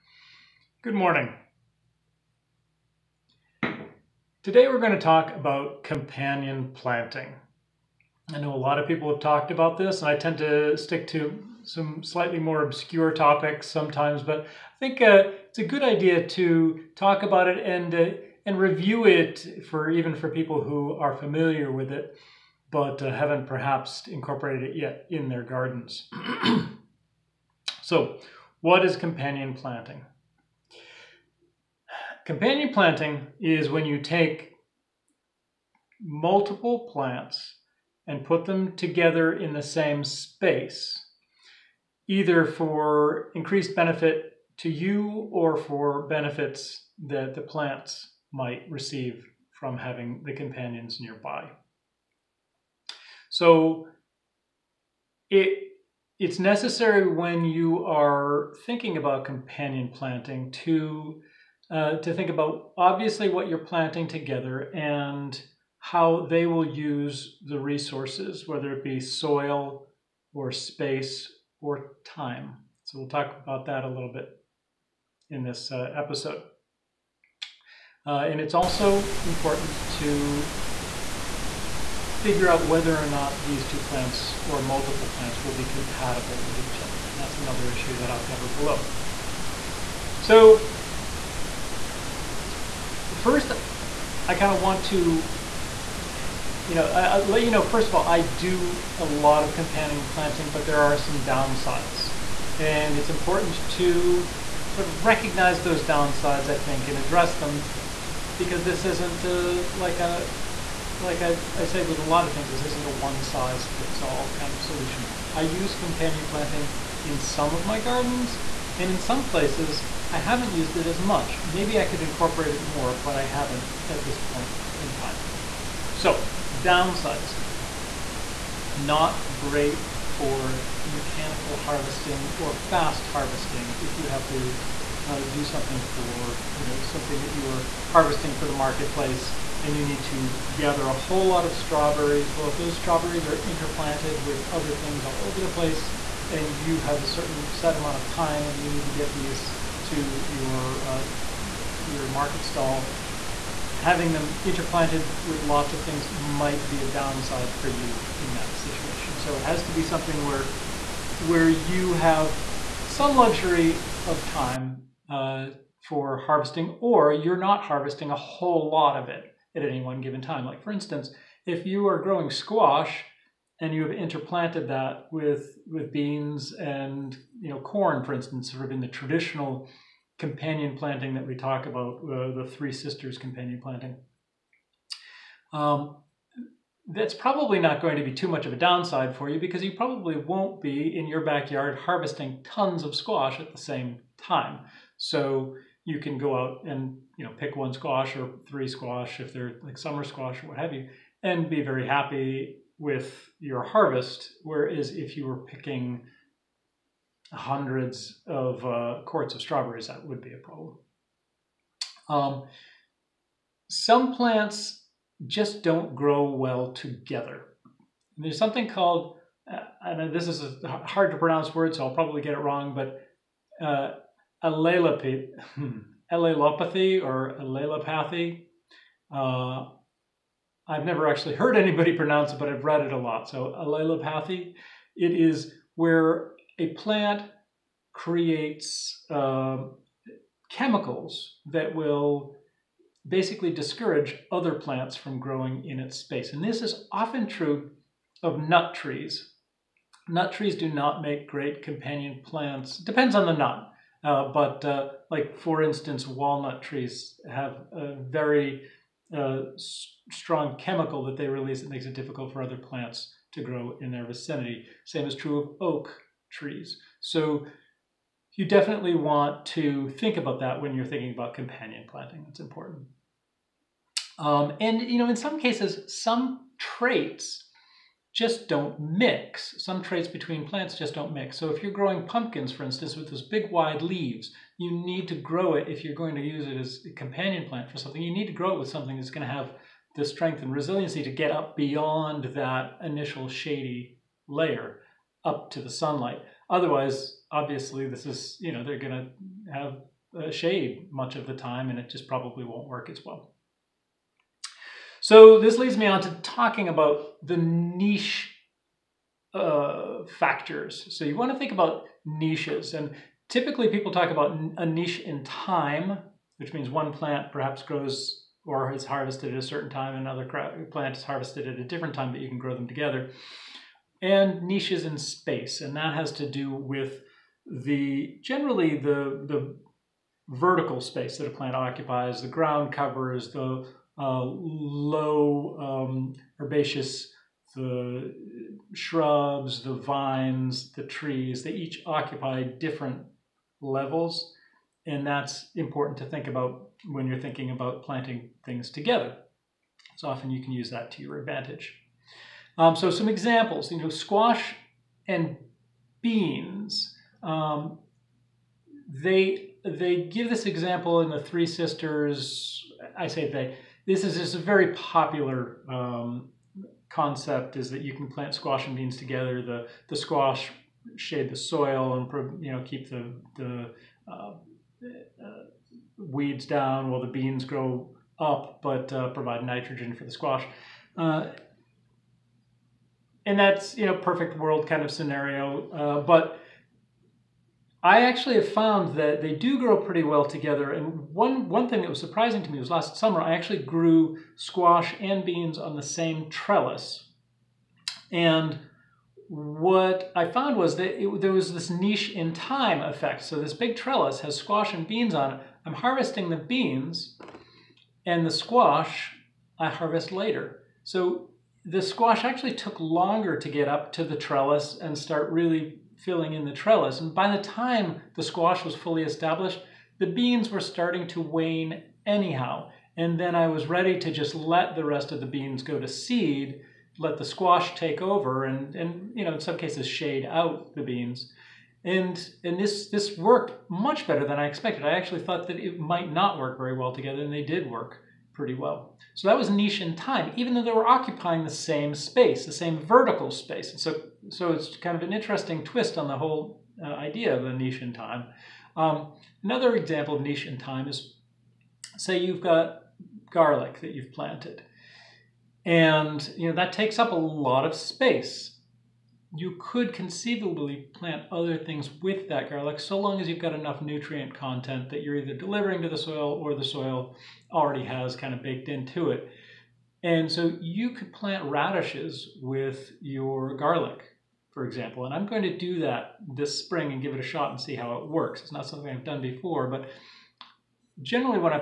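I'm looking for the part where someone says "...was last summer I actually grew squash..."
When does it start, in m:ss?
6:32.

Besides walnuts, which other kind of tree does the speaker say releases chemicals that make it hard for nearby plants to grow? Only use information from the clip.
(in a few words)
oak trees.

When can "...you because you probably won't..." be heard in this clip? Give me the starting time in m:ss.
3:09.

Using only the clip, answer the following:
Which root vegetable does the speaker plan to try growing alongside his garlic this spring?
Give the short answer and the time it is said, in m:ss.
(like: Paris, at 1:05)
radishes, at 7:51.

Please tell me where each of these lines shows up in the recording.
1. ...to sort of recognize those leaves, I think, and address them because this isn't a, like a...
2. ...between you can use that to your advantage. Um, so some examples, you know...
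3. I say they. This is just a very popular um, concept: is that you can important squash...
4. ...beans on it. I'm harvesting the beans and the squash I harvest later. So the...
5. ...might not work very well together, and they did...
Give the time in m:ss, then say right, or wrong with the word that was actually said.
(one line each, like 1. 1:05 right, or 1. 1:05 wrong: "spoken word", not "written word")
1. 1:43 wrong: "downsides", not "leaves"
2. 5:50 wrong: "often", not "between"
3. 6:02 wrong: "plant", not "important"
4. 6:44 right
5. 7:15 right.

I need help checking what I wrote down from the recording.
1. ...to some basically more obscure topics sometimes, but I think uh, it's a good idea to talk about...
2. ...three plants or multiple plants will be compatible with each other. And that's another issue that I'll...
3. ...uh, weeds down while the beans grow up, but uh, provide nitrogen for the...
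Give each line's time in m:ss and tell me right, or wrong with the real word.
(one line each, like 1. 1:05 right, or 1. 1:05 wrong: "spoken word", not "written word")
1. 0:11 wrong: "slightly", not "basically"
2. 1:23 wrong: "two", not "three"
3. 6:14 right.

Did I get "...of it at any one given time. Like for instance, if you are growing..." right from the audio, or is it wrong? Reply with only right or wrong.
right.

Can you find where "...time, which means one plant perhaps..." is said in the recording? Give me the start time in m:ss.
5:15.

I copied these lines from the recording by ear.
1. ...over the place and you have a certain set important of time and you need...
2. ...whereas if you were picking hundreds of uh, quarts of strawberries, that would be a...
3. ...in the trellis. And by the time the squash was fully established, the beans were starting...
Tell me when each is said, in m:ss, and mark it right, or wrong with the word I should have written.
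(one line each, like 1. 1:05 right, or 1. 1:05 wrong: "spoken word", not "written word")
1. 2:25 wrong: "amount", not "important"
2. 3:24 right
3. 6:56 right.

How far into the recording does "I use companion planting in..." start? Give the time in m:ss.
1:55.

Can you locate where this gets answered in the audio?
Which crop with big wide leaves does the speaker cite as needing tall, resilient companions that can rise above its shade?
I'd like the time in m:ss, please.
4:42.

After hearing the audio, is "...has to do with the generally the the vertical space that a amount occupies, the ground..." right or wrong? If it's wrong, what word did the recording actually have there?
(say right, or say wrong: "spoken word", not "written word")
wrong: "plant", not "amount".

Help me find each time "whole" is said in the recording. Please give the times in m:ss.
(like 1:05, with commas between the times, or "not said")
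2:20, 2:48, 7:26.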